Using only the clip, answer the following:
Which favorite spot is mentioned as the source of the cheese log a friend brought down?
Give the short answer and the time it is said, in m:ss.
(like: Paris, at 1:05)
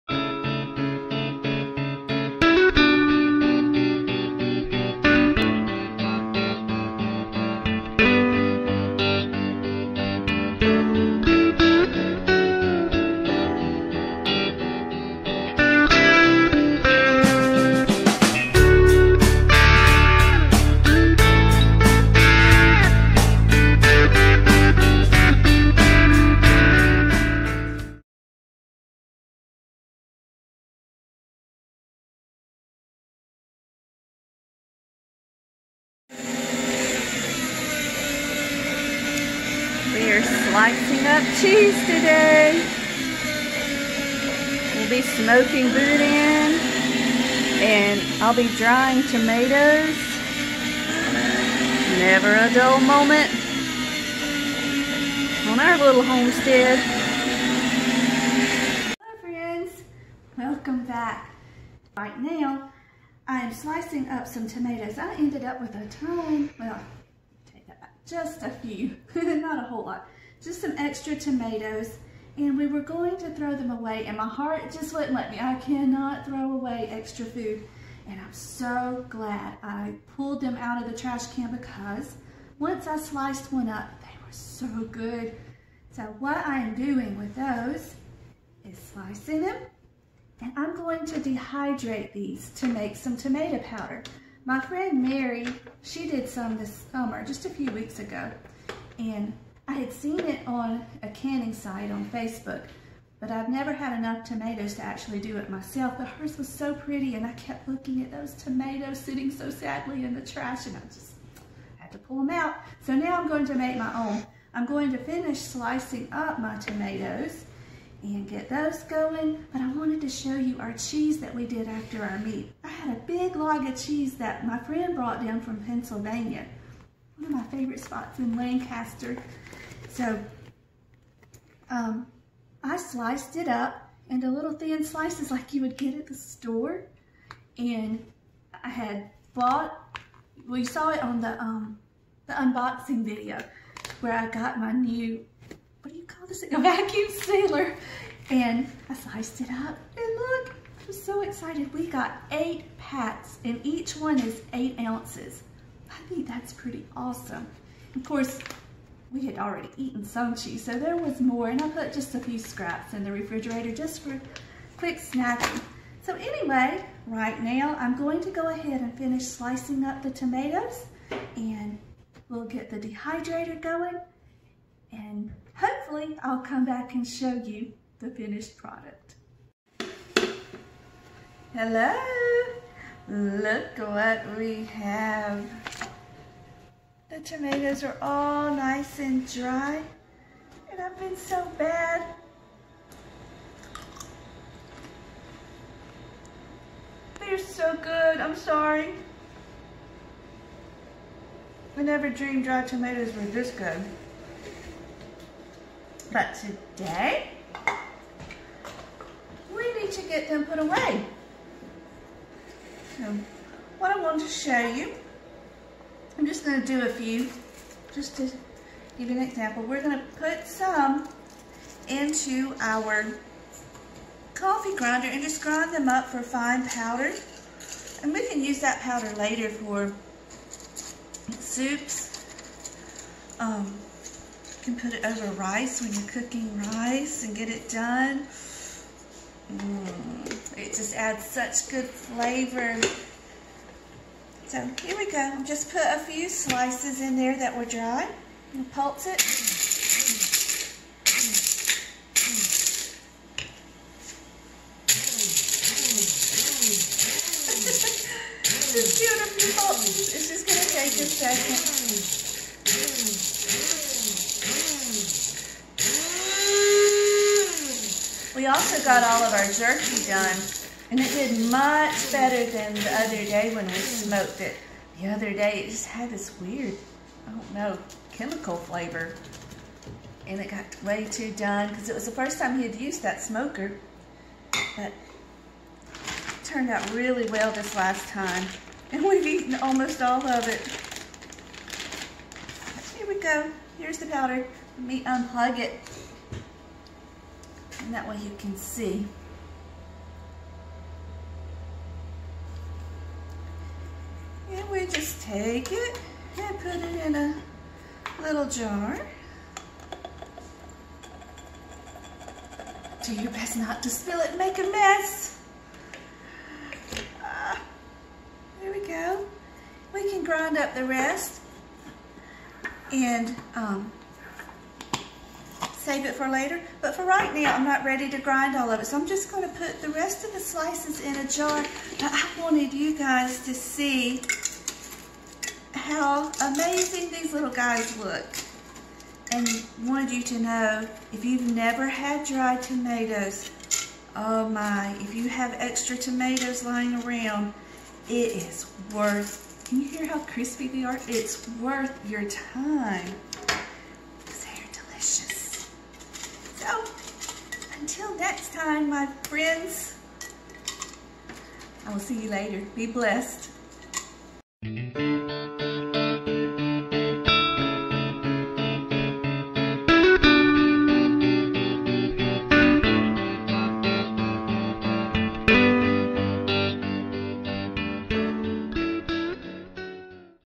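Lancaster, at 2:08.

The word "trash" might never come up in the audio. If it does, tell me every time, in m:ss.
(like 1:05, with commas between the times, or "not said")
1:20, 1:50.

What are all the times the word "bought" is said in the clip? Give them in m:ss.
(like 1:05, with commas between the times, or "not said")
2:19.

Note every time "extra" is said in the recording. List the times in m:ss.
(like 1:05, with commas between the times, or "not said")
1:10, 1:16, 5:45.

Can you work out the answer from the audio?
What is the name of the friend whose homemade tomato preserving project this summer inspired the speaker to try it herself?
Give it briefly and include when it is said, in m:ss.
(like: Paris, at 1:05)
Mary, at 1:35.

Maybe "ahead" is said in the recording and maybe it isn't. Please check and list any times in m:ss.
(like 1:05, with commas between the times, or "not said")
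2:48.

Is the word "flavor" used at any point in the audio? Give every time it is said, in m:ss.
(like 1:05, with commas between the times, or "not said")
4:01, 4:38.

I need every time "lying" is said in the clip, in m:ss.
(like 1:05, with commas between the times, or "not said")
5:46.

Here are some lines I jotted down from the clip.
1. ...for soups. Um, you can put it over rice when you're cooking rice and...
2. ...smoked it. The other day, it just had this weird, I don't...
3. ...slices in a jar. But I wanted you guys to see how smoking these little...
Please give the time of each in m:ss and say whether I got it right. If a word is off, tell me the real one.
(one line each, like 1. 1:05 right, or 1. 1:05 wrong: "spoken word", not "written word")
1. 3:49 right
2. 4:33 right
3. 5:30 wrong: "amazing", not "smoking".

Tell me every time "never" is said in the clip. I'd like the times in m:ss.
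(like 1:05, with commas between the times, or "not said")
0:51, 1:43, 3:21, 5:41.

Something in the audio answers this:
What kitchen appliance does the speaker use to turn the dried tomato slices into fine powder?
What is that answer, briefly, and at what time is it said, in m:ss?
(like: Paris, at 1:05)
Coffee grinder, at 3:44.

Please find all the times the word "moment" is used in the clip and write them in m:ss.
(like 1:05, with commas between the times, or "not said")
0:52.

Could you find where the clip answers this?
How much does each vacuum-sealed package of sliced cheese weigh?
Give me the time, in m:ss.
2:34.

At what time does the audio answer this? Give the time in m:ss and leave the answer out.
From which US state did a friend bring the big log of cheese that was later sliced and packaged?
2:05.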